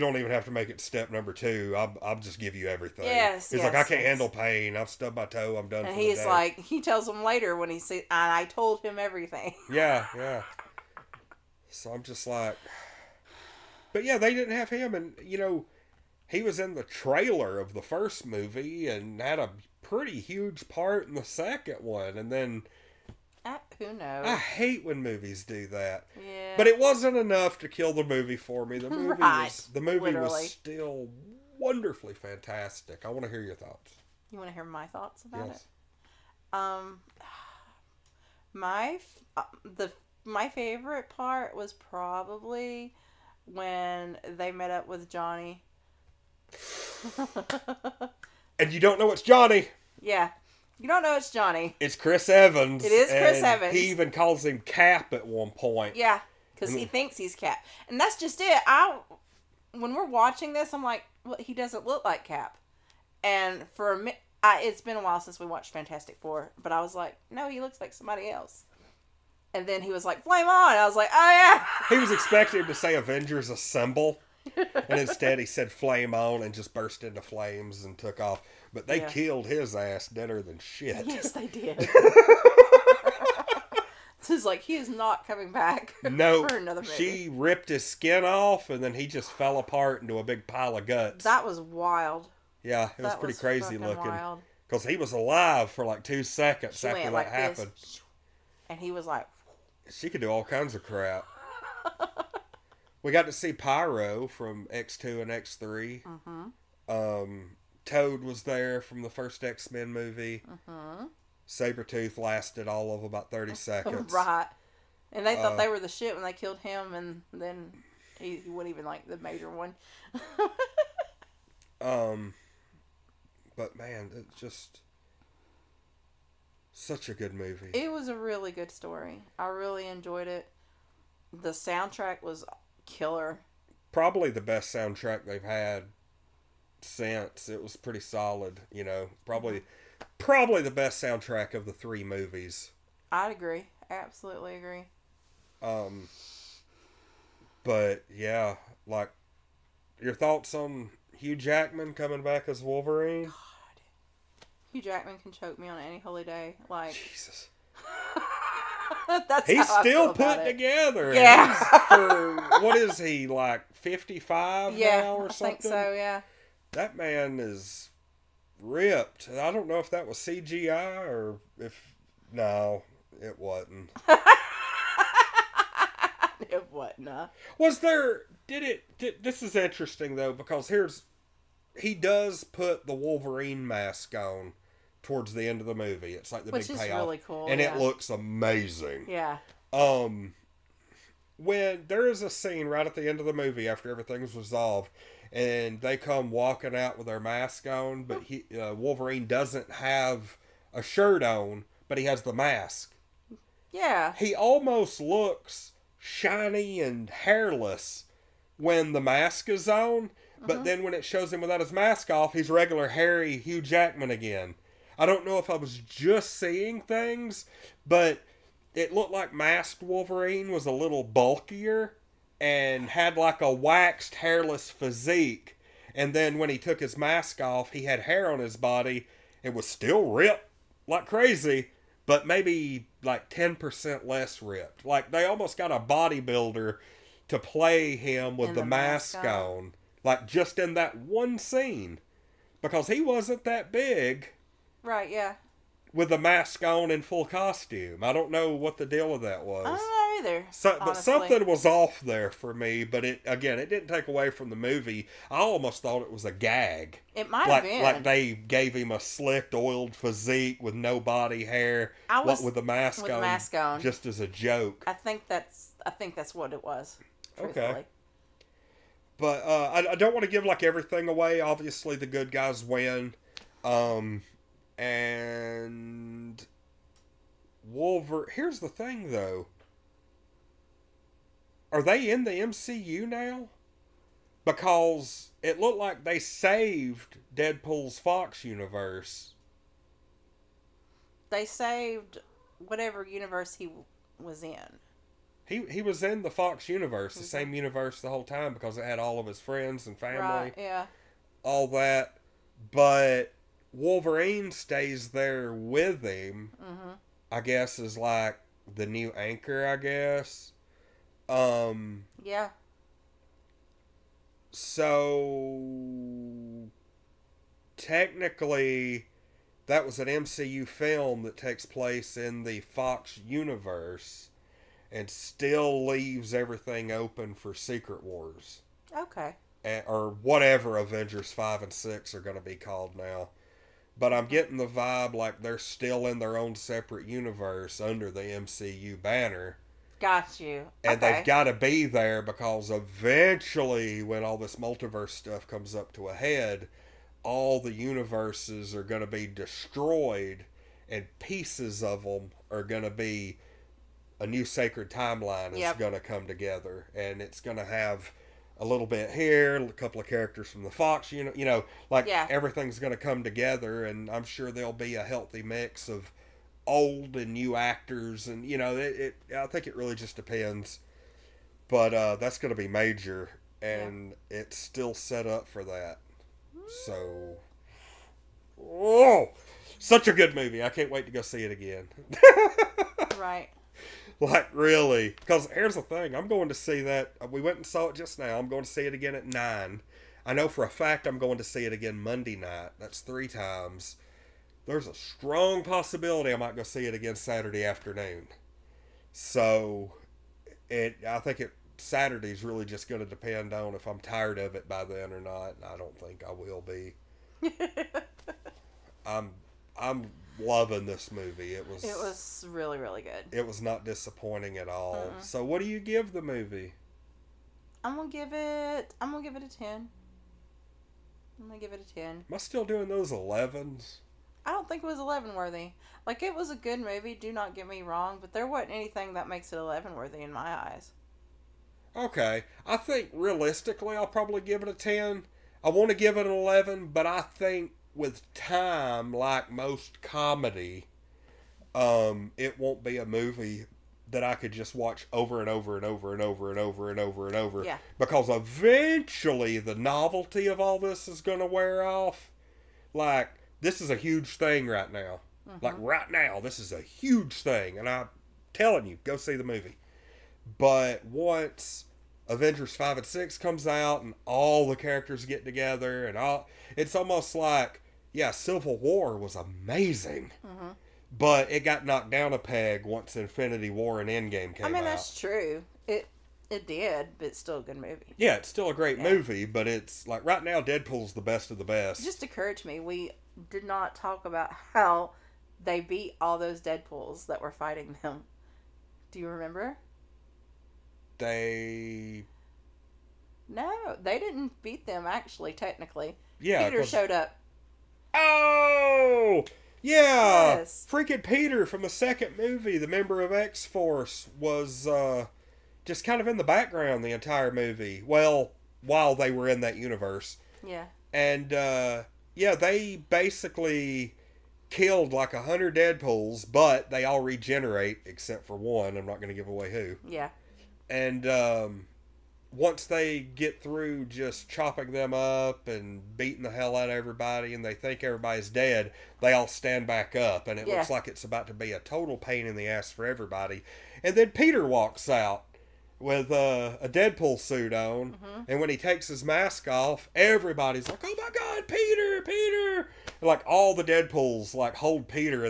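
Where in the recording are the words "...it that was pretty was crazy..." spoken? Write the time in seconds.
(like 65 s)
92 s.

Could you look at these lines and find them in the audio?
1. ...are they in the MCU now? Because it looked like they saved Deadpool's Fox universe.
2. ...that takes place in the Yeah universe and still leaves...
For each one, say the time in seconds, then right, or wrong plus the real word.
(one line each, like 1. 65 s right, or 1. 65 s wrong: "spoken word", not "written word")
1. 281 s right
2. 321 s wrong: "Fox", not "Yeah".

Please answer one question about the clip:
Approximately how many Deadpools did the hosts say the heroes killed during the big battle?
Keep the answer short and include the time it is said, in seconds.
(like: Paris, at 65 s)
100, at 515 s.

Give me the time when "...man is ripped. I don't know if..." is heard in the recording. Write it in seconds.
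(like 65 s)
166 s.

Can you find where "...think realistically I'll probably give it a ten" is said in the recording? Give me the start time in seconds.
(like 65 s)
432 s.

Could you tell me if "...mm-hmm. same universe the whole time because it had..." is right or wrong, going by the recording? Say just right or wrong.
right.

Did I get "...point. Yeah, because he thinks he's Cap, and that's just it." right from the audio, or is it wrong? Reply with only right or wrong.
right.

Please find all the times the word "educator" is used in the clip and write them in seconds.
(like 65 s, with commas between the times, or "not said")
not said.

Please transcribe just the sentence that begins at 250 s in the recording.
So, but something was off there for me.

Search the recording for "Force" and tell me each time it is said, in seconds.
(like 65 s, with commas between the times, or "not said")
503 s.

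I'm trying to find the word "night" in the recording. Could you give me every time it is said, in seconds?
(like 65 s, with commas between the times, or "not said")
392 s.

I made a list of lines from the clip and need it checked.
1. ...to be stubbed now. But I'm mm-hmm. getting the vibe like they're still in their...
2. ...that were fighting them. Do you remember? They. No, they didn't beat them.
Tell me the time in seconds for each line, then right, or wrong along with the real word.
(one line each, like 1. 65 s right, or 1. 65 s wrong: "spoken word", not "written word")
1. 332 s wrong: "called", not "stubbed"
2. 487 s right.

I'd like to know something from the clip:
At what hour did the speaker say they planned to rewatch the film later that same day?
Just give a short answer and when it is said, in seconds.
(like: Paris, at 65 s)
9, at 389 s.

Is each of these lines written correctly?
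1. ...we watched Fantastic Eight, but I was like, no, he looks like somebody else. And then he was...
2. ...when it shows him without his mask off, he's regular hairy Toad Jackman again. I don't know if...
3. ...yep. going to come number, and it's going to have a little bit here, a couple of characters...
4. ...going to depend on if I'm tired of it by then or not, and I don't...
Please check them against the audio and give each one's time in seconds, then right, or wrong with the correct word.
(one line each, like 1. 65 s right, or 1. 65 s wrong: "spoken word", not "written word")
1. 65 s wrong: "Four", not "Eight"
2. 210 s wrong: "Hugh", not "Toad"
3. 355 s wrong: "together", not "number"
4. 402 s right.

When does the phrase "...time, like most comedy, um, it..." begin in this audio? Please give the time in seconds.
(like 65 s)
438 s.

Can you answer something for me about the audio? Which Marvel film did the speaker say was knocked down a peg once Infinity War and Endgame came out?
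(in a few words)
Civil War.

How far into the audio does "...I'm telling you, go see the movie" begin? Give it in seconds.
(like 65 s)
457 s.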